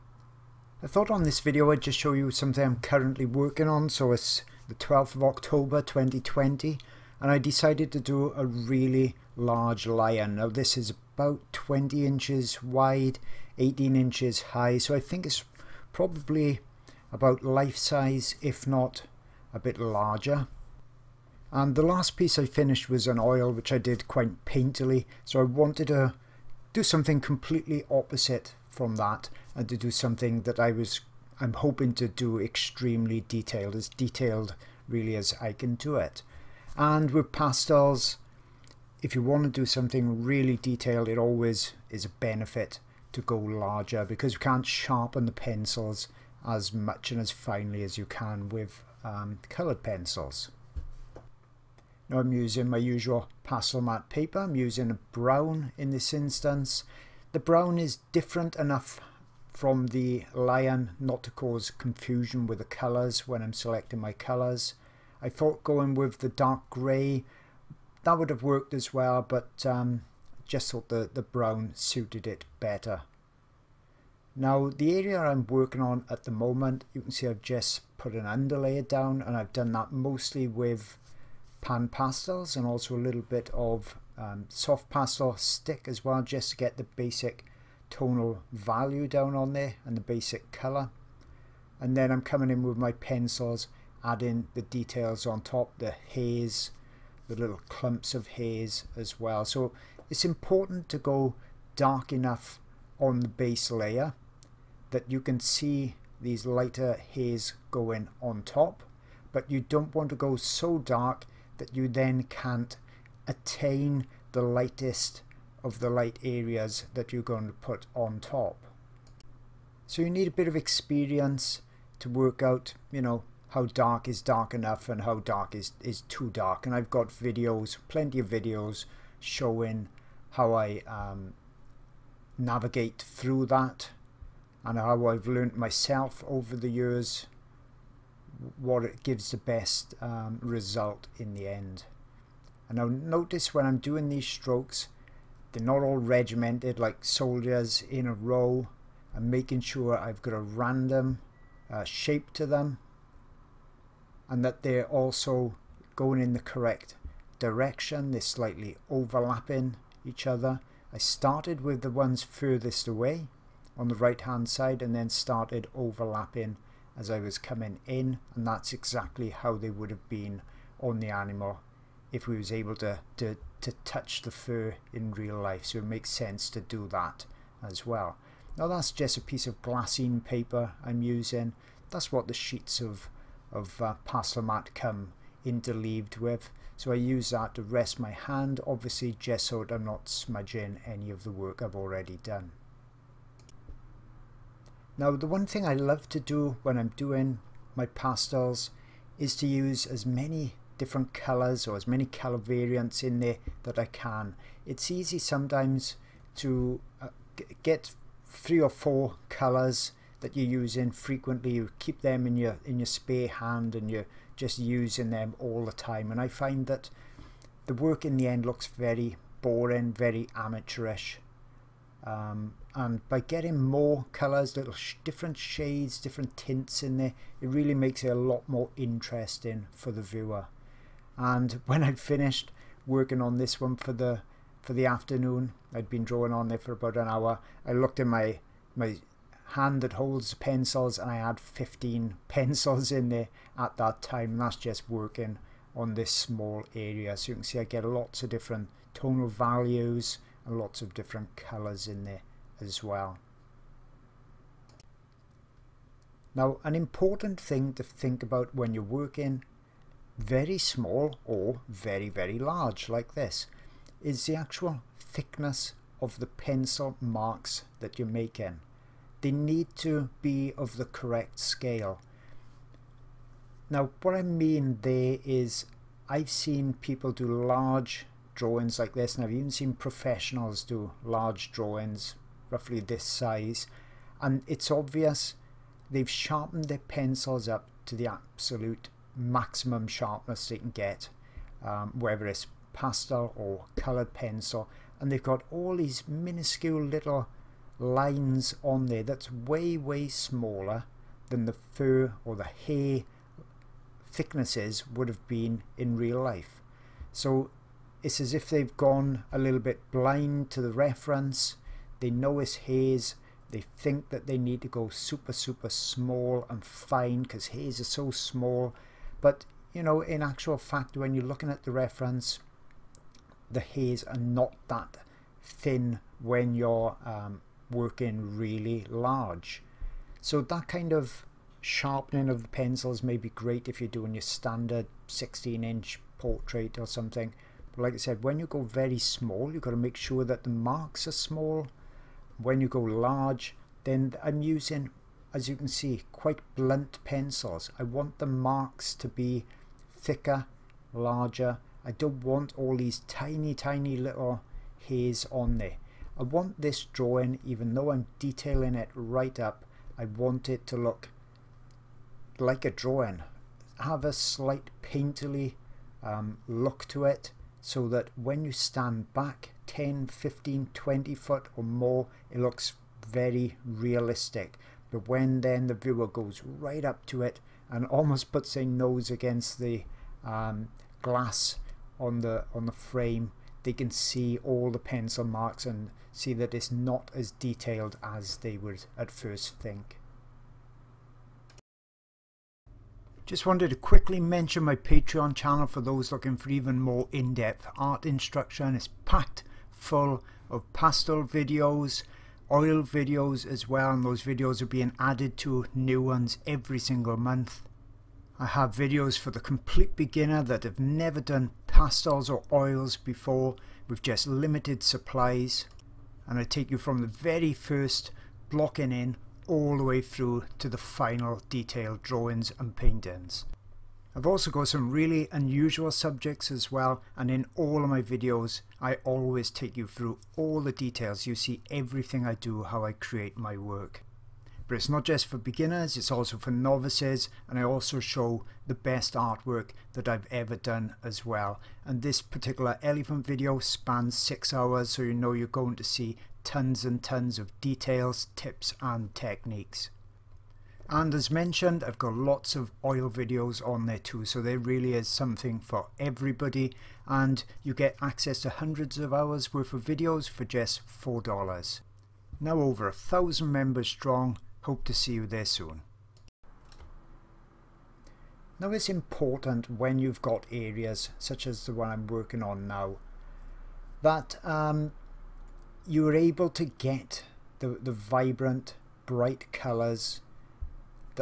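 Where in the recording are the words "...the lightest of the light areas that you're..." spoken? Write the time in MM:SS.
01:54.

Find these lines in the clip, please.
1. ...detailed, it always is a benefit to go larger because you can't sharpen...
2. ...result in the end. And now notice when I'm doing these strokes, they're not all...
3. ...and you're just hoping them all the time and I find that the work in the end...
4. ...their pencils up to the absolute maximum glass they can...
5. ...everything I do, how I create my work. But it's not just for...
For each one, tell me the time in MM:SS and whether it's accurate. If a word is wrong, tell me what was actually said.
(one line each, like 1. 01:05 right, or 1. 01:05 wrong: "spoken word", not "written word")
1. 00:40 right
2. 02:20 right
3. 03:33 wrong: "using", not "hoping"
4. 04:46 wrong: "sharpness", not "glass"
5. 07:11 right.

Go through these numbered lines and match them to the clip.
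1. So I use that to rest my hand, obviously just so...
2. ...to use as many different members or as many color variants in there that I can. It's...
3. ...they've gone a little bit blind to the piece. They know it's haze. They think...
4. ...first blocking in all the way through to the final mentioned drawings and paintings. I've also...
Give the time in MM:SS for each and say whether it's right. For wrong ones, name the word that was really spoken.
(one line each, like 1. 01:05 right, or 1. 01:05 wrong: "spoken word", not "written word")
1. 03:06 right
2. 03:19 wrong: "colors", not "members"
3. 05:08 wrong: "reference", not "piece"
4. 06:57 wrong: "detailed", not "mentioned".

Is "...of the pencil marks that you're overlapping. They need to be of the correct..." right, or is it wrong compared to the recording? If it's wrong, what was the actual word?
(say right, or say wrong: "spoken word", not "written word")
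wrong: "making", not "overlapping".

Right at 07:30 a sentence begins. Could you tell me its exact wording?
And as mentioned, I've got lots of oil videos on there too, so there really is something for everybody.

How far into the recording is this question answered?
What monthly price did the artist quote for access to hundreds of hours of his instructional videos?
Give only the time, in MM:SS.
07:40.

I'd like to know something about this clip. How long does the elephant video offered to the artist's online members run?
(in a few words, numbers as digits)
6 hours.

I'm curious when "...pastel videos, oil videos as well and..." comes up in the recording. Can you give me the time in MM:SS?
06:40.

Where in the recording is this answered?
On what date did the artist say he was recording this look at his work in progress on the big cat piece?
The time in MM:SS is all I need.
00:04.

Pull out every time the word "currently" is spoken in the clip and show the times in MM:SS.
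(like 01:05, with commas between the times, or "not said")
00:02.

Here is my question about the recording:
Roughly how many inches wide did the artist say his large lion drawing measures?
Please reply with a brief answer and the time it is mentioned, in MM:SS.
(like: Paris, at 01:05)
20 inches, at 00:11.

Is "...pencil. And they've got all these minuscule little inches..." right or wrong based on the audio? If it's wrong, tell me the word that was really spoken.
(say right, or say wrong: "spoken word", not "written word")
wrong: "lines", not "inches".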